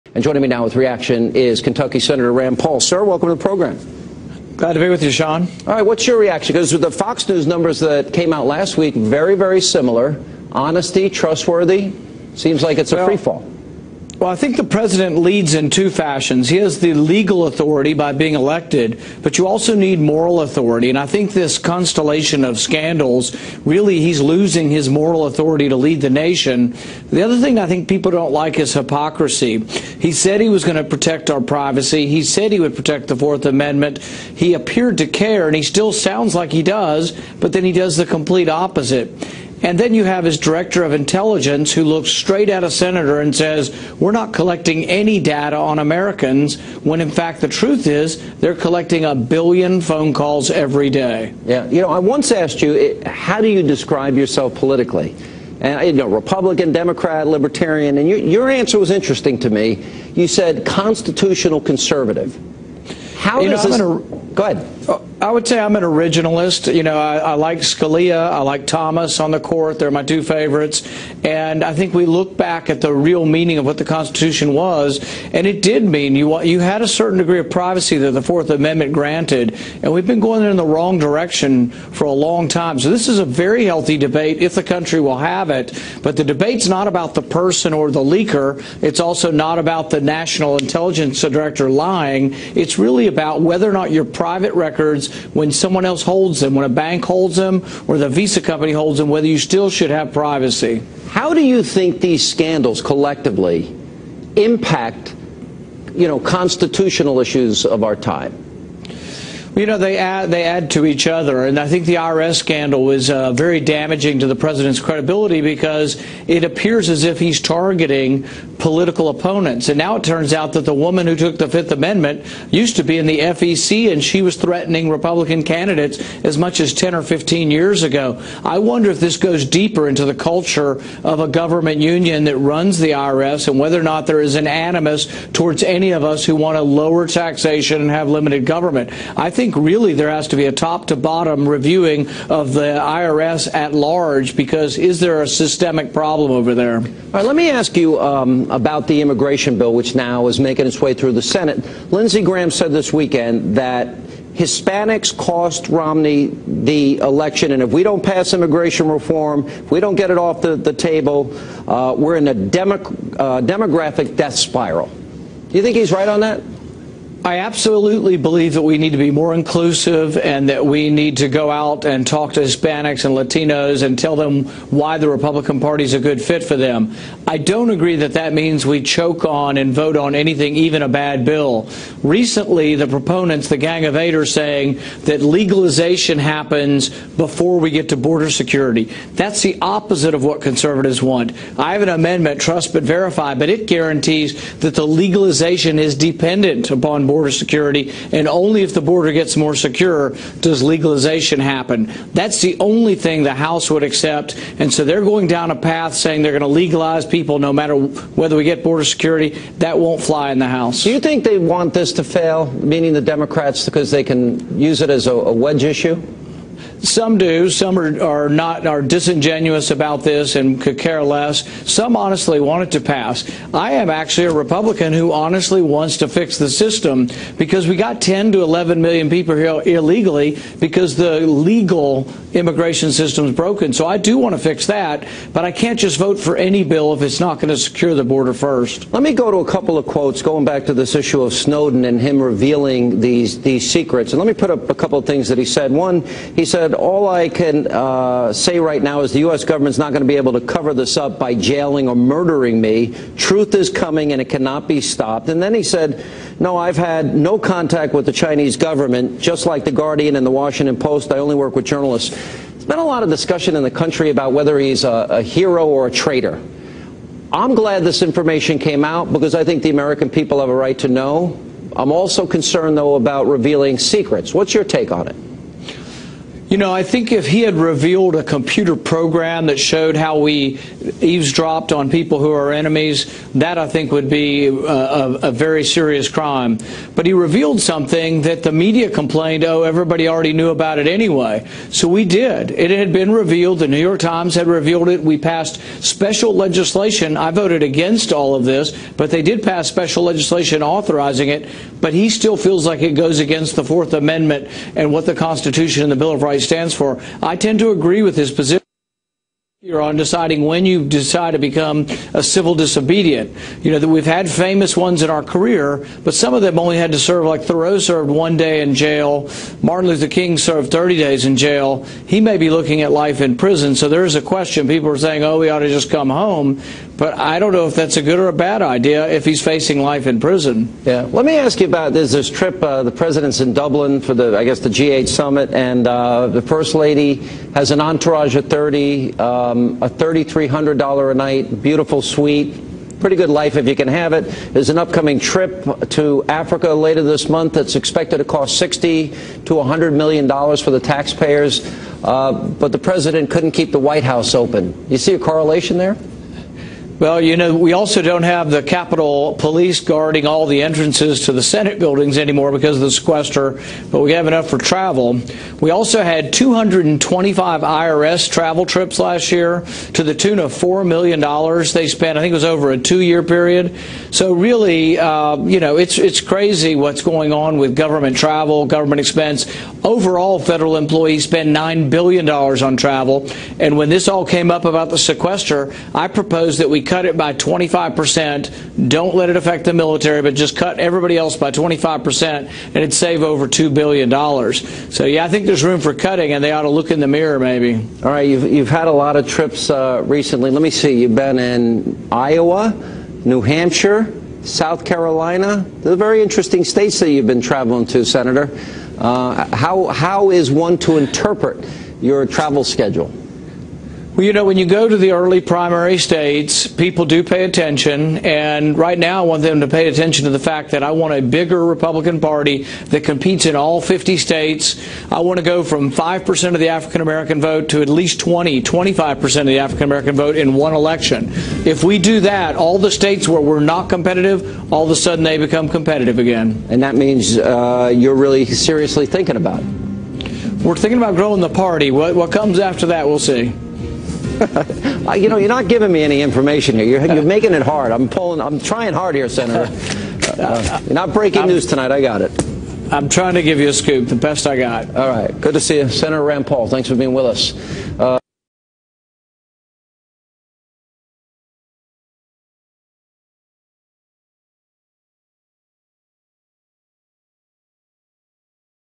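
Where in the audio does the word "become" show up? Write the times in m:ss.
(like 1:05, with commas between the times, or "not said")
5:11, 7:15.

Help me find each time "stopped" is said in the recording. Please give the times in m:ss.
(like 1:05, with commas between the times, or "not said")
4:14.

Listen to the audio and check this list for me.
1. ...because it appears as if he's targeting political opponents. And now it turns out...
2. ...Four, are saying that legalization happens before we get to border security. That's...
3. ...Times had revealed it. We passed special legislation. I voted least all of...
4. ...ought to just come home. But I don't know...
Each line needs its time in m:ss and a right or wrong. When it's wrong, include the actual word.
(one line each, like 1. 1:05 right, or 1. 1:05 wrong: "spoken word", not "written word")
1. 1:55 right
2. 3:03 wrong: "Eight", not "Four"
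3. 4:54 wrong: "against", not "least"
4. 5:25 right.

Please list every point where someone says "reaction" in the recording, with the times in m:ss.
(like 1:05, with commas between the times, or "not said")
0:00, 0:06.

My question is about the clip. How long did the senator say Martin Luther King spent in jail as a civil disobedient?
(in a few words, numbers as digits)
30 days.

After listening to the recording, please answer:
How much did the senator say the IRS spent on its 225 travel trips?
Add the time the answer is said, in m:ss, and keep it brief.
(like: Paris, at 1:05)
$4 million, at 6:10.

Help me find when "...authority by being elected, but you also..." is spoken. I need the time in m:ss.
0:17.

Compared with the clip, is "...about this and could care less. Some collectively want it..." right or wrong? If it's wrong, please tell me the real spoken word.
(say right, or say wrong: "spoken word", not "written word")
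wrong: "honestly", not "collectively".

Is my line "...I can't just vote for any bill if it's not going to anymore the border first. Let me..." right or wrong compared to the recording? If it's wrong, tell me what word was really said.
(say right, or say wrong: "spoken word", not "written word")
wrong: "secure", not "anymore".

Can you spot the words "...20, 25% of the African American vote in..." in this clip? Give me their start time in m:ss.
7:08.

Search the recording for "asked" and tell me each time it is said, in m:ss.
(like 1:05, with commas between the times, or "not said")
0:52.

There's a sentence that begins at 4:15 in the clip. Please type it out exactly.
And then he said, No, I've had no contact with the Chinese government, just like The Guardian and The Washington Post.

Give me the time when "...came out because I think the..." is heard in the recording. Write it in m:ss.
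4:28.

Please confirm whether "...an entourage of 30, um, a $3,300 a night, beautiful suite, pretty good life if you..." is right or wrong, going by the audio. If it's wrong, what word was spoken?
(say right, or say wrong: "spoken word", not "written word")
right.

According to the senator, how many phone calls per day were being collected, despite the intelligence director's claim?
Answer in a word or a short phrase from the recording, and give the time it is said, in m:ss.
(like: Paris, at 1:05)
a billion, at 0:49.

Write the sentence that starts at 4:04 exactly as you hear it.
And let me put up a couple of things that he said.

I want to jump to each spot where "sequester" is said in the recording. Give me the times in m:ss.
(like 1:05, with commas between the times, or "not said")
6:02, 6:24.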